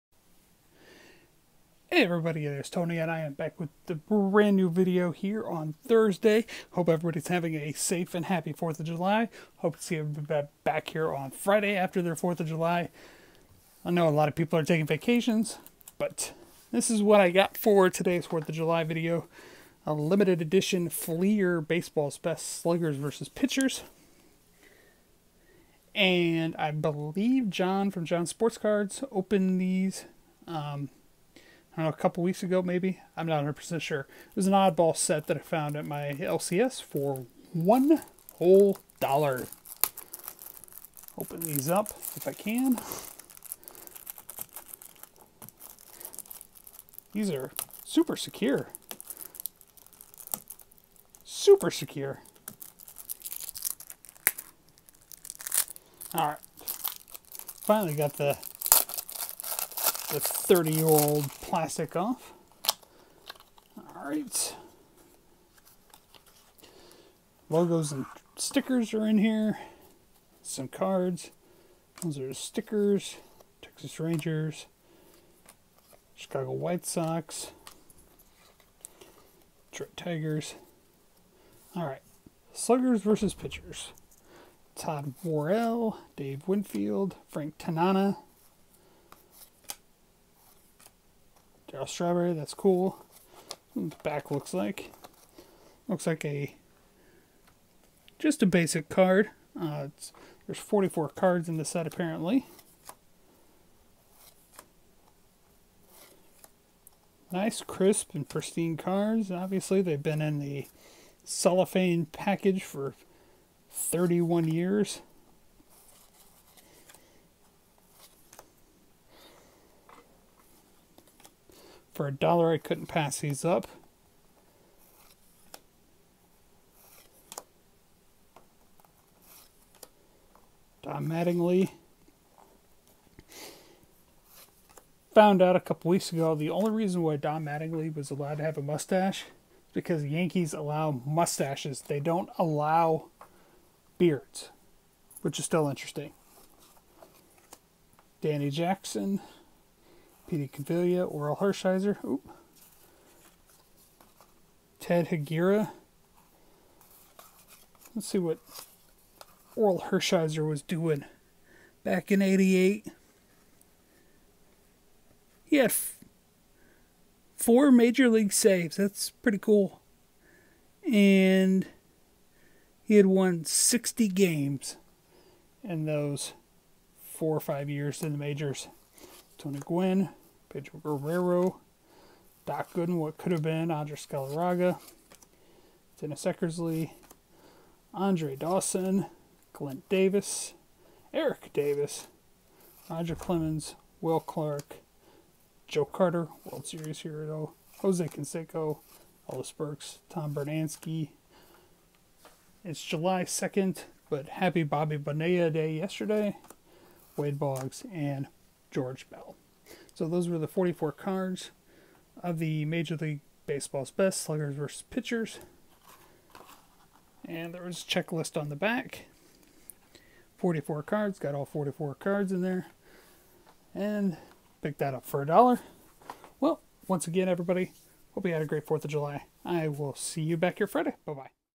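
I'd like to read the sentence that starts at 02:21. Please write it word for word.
They don't allow beards, which is still interesting.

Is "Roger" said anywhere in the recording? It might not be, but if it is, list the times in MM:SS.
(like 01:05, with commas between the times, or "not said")
03:12.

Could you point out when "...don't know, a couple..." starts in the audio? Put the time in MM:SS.
00:31.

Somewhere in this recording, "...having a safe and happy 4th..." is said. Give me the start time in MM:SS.
00:07.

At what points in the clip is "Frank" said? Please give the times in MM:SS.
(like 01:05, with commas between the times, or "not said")
01:27.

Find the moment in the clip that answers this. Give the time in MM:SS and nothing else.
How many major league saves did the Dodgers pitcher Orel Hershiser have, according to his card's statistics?
02:47.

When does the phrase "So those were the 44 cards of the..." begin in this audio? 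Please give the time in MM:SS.
03:30.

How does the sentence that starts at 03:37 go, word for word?
And there was a checklist on the back.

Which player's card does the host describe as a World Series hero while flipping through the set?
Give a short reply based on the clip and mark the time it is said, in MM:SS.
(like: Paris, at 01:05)
Joe Carter, at 03:15.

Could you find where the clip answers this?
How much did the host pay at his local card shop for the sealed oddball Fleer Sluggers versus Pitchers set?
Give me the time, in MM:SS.
00:37.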